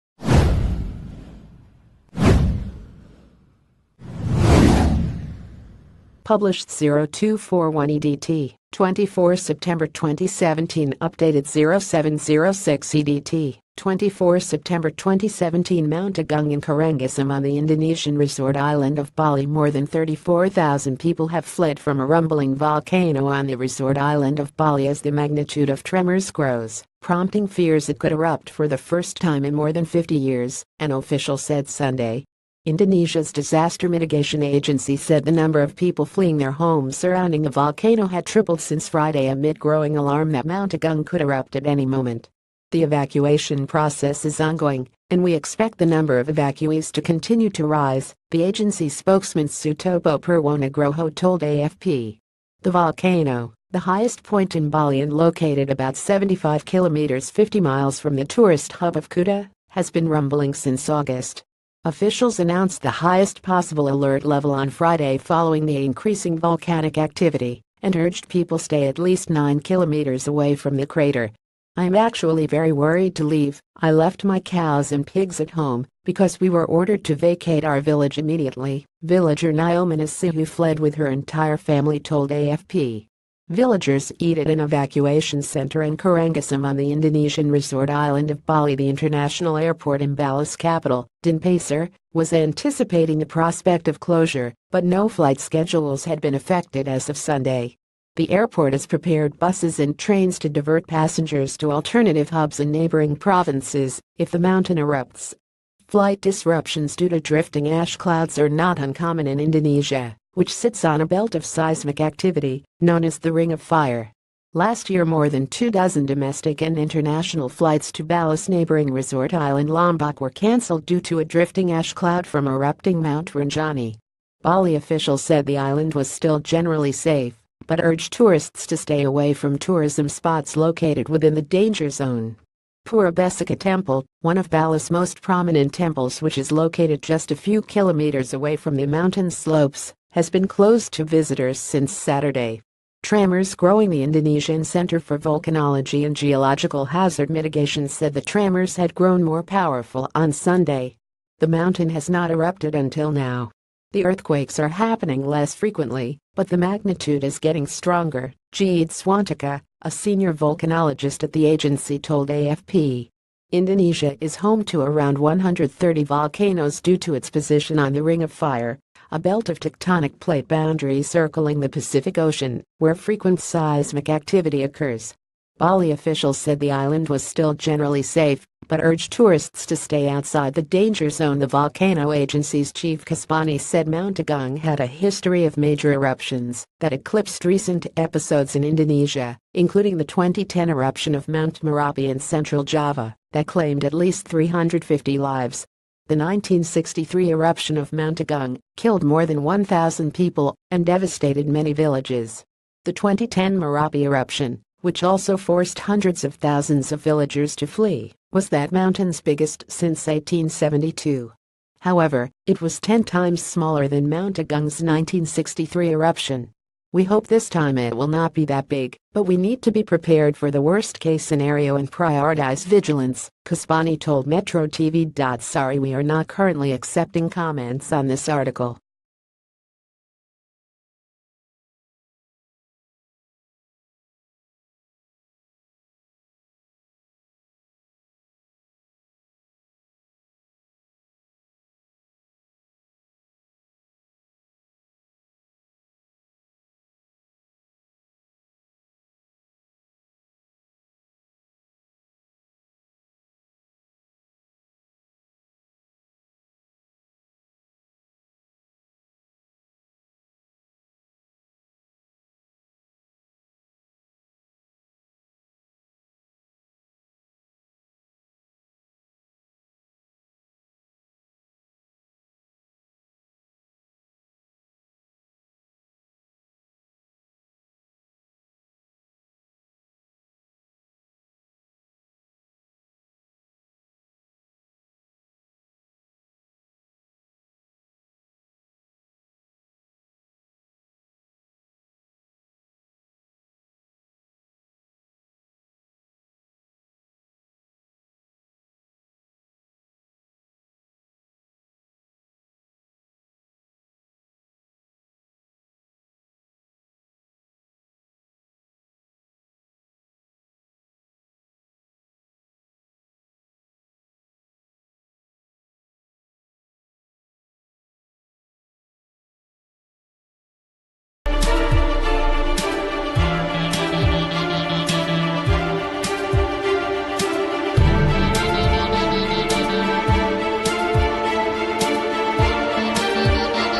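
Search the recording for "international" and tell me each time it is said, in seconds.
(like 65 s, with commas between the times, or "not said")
88 s, 116 s.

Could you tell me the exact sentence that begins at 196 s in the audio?
The 1963 eruption of Mount Agung killed more than 1,000 people and devastated many villages.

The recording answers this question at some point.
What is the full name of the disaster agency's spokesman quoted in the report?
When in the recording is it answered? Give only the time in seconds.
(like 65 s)
49 s.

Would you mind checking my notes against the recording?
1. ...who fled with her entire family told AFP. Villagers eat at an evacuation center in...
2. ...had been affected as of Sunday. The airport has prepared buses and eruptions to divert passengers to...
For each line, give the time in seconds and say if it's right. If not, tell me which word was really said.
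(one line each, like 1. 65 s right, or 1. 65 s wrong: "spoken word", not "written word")
1. 80 s right
2. 96 s wrong: "trains", not "eruptions".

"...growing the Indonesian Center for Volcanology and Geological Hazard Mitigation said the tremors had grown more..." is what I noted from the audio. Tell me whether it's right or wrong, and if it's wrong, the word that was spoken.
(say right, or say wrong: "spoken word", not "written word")
right.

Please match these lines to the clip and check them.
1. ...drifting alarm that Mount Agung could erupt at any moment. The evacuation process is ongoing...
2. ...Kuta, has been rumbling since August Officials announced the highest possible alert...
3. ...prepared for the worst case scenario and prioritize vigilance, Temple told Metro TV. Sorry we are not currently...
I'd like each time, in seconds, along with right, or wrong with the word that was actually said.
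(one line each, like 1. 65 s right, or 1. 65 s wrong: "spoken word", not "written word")
1. 39 s wrong: "growing", not "drifting"
2. 59 s right
3. 219 s wrong: "Kasbani", not "Temple".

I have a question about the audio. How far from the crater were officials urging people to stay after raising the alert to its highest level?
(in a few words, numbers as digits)
9 kilometers.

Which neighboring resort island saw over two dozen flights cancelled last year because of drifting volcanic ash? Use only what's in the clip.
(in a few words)
Lombok.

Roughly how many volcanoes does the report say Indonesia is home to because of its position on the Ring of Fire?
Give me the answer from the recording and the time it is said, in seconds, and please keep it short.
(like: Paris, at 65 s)
130, at 165 s.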